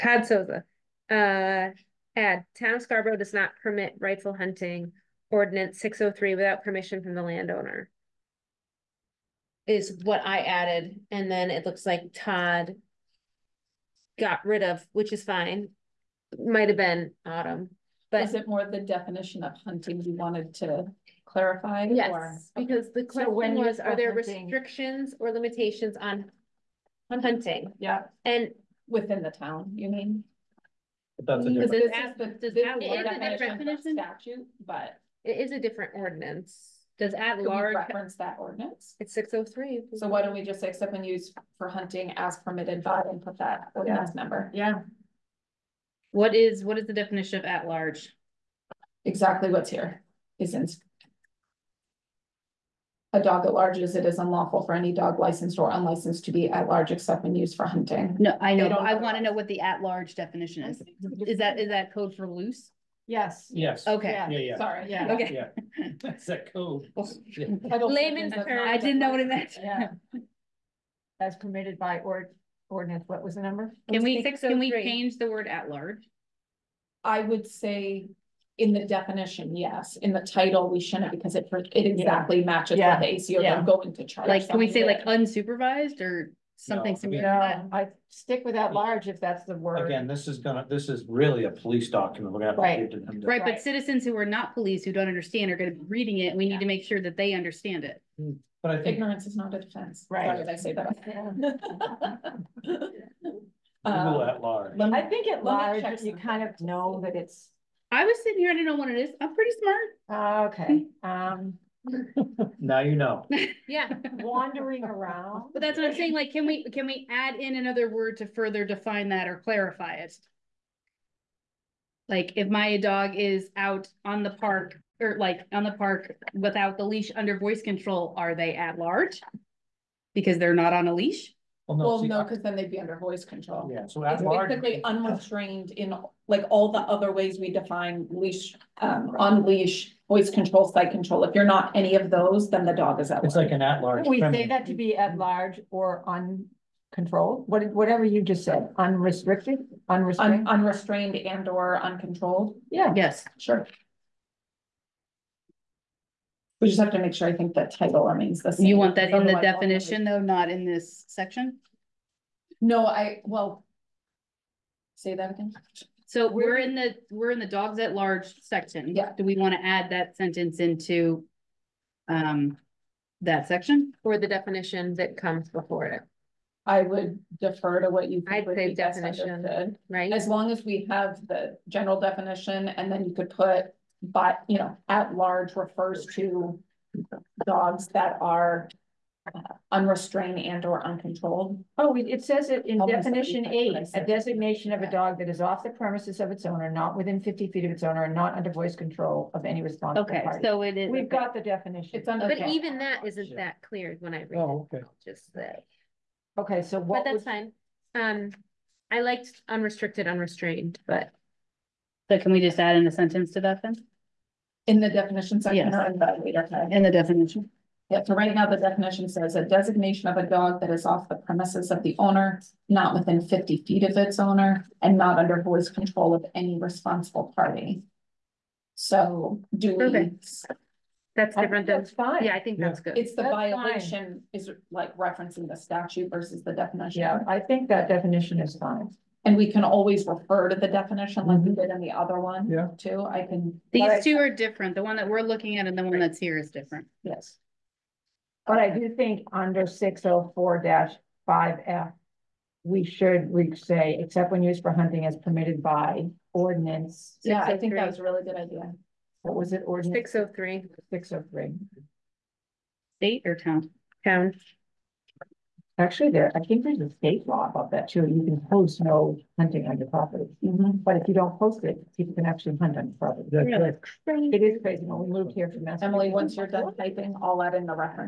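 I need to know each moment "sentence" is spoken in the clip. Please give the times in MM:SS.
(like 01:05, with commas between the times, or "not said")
02:50, 03:32.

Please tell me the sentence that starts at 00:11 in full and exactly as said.
And then it looks like Todd got rid of, which is fine.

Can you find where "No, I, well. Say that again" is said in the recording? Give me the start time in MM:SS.
02:42.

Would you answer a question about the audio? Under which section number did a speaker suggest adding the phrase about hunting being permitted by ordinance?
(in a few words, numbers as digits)
604.5F.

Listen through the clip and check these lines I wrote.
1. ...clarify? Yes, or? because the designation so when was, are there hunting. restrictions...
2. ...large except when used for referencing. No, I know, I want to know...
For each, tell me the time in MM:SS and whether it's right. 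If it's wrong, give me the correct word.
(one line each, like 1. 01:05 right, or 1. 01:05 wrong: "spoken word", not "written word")
1. 00:21 wrong: "question", not "designation"
2. 00:56 wrong: "hunting", not "referencing".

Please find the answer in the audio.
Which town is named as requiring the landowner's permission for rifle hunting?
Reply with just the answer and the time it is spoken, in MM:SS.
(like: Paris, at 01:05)
Scarborough, at 00:02.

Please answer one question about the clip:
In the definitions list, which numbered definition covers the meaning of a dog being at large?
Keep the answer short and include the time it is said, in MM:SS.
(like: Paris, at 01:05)
8, at 03:13.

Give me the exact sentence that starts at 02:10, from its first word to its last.
Because they're not on a leash?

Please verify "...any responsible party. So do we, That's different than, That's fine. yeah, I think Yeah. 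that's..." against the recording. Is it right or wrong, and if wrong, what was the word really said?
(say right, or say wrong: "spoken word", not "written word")
right.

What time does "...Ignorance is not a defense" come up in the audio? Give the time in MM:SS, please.
01:38.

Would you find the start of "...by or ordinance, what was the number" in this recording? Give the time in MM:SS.
01:11.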